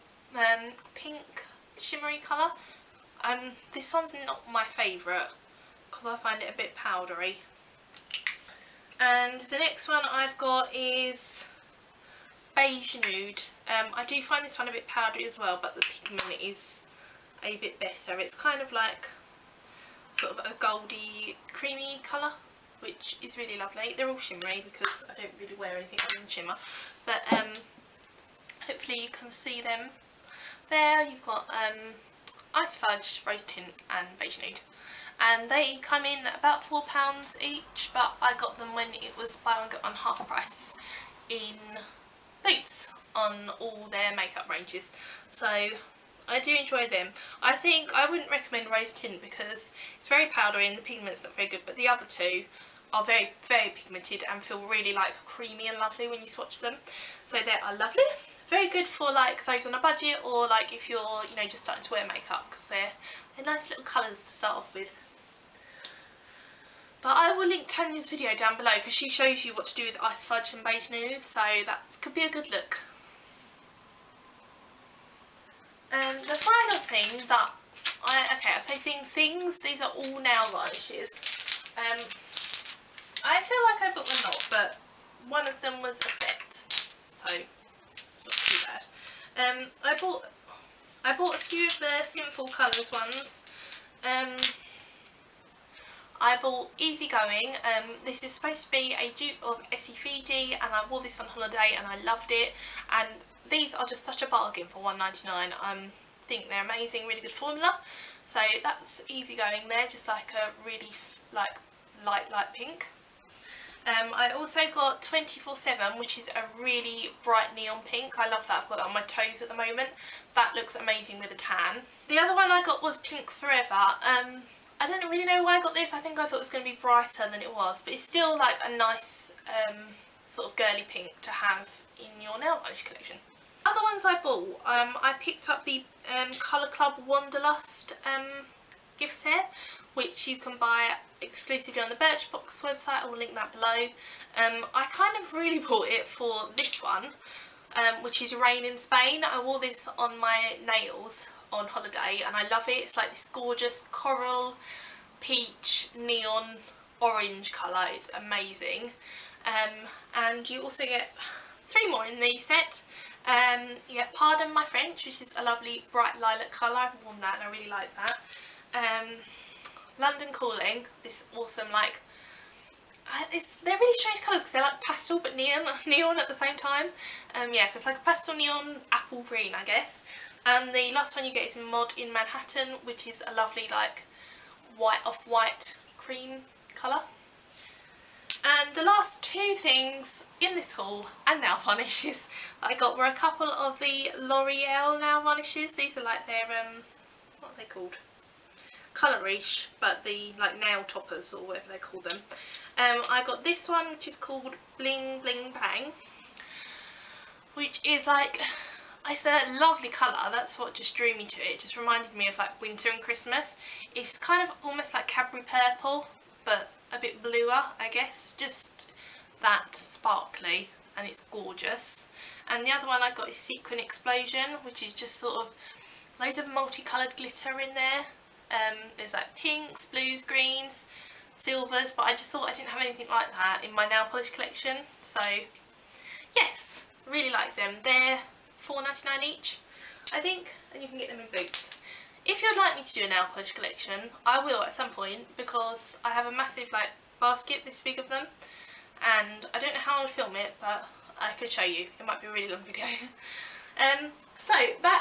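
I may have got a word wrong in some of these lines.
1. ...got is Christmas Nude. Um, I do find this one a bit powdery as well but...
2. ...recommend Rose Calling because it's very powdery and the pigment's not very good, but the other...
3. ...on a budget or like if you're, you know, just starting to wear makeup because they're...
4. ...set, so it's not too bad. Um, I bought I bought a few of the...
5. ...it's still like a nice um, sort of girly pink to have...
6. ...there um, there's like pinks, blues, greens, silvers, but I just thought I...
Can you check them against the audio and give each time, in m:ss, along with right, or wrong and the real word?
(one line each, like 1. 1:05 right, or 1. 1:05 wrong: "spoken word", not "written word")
1. 0:10 wrong: "Beige", not "Christmas"
2. 0:48 wrong: "Tint", not "Calling"
3. 0:59 right
4. 1:26 right
5. 2:07 right
6. 3:47 right.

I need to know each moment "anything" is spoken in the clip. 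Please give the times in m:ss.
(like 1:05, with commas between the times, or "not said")
0:25, 3:52.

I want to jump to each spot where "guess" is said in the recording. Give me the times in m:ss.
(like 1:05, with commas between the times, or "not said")
2:59, 3:37.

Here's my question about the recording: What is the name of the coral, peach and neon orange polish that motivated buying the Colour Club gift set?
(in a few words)
Rain in Spain.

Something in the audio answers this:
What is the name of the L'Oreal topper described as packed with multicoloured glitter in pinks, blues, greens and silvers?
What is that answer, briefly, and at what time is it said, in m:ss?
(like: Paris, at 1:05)
Sequin Explosion, at 3:43.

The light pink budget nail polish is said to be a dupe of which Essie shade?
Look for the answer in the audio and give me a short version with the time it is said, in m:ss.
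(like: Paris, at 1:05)
Essie Fiji, at 1:39.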